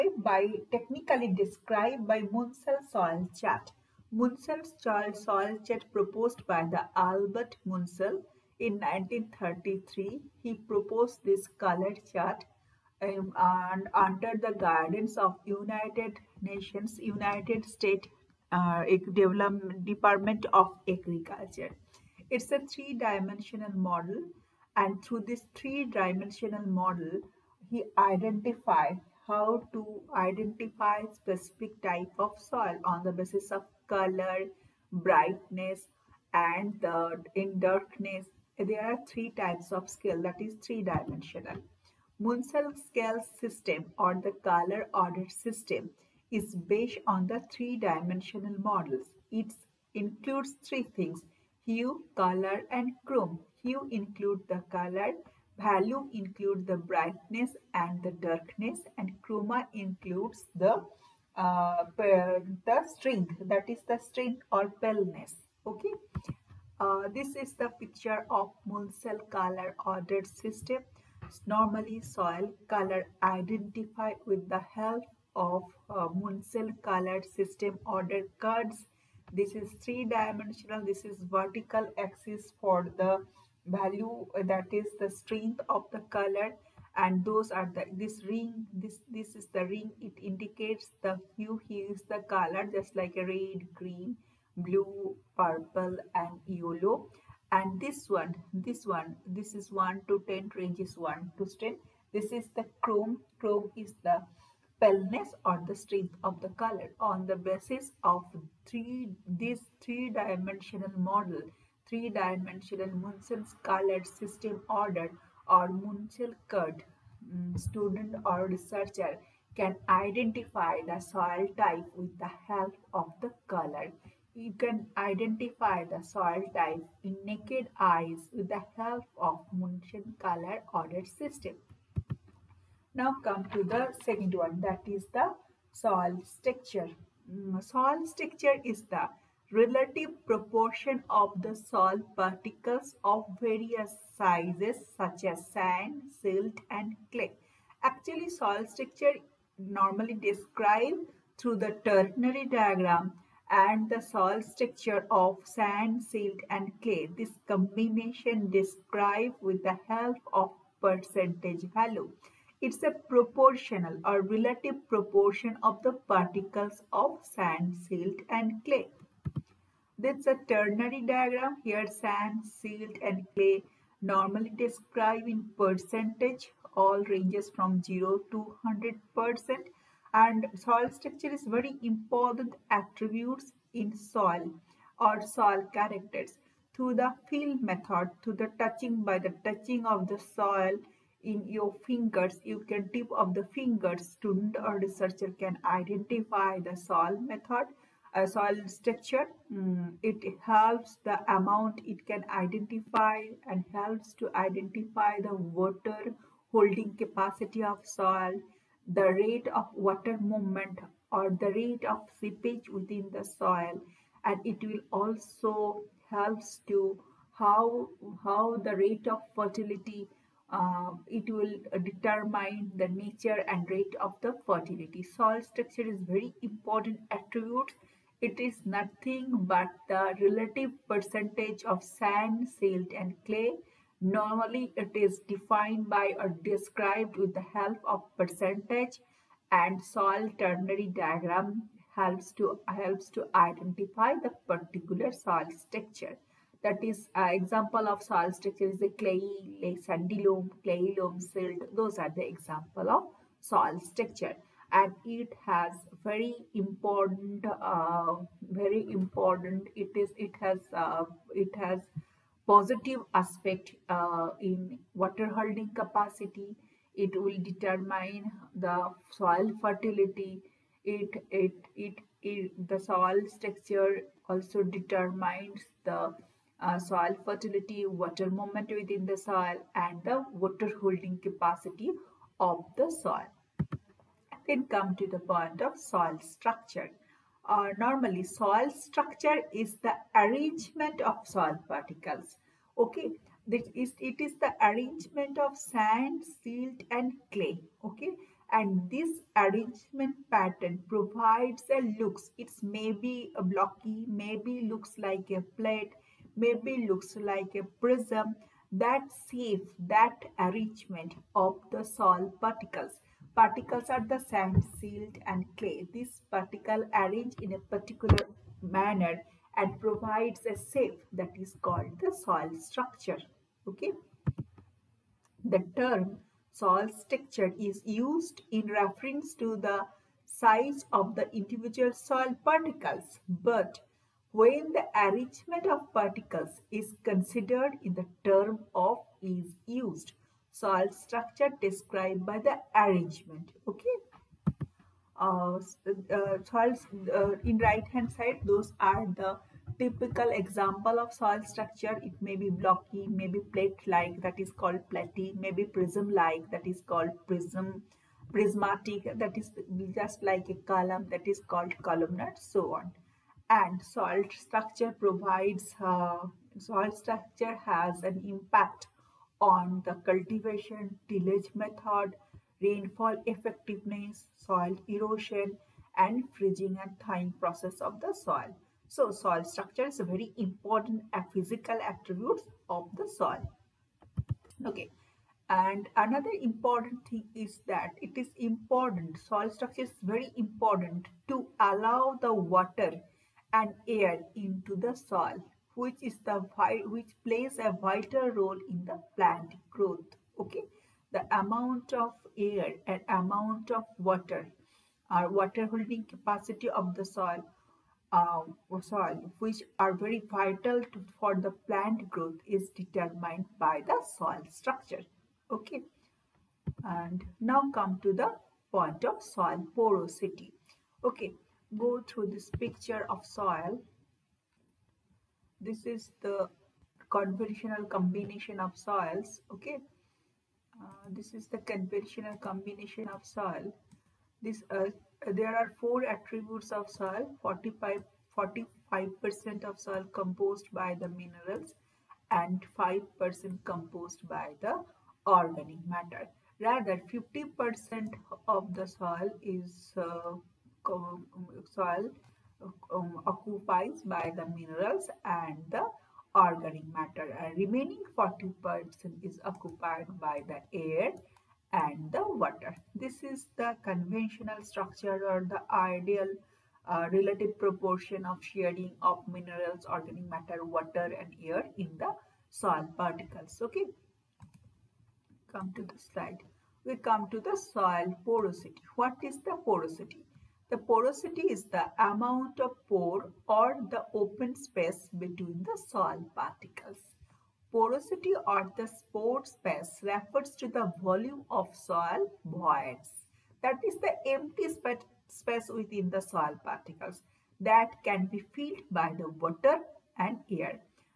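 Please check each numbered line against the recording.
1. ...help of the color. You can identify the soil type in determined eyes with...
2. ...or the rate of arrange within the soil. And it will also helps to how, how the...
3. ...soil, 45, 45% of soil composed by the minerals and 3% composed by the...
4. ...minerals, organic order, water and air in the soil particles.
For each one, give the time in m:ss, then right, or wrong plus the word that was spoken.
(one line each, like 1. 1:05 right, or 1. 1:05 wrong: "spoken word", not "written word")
1. 2:02 wrong: "naked", not "determined"
2. 3:31 wrong: "seepage", not "arrange"
3. 7:16 wrong: "5", not "3"
4. 7:49 wrong: "matter", not "order".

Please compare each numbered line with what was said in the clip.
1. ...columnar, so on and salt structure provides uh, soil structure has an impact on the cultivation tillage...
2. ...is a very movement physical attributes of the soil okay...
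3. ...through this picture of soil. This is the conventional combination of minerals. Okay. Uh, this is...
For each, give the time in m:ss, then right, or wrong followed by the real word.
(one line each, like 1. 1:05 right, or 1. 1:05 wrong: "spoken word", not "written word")
1. 6:01 right
2. 6:19 wrong: "important", not "movement"
3. 7:02 wrong: "soils", not "minerals".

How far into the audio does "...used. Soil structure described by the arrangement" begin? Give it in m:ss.
5:39.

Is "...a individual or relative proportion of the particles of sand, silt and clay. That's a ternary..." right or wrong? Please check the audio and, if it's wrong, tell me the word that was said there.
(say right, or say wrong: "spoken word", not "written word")
wrong: "proportional", not "individual".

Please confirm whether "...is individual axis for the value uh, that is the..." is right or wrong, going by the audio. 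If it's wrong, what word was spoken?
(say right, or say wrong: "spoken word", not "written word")
wrong: "vertical", not "individual".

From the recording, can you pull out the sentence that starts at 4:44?
Then come to the point of soil structure.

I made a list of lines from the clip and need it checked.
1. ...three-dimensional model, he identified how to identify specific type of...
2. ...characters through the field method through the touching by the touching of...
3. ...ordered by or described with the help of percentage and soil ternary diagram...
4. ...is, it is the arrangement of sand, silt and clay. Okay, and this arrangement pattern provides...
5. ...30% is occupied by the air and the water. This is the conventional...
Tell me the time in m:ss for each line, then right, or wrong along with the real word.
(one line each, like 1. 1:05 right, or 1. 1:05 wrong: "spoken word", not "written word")
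1. 0:25 right
2. 3:05 right
3. 3:55 wrong: "defined", not "ordered"
4. 4:53 right
5. 7:38 wrong: "40", not "30".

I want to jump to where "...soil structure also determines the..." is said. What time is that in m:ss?
4:32.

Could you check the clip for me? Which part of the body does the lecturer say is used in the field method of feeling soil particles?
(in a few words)
tip of the finger.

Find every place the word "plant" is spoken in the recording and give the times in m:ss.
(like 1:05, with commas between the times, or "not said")
6:39, 6:51.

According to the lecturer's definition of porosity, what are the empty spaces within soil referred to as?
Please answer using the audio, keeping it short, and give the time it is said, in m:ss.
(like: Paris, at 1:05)
soil voids, at 8:11.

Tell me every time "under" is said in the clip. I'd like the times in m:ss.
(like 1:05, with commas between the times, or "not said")
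0:13.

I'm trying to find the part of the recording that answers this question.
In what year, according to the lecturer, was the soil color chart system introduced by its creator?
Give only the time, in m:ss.
0:08.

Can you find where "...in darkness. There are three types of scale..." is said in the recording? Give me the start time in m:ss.
0:37.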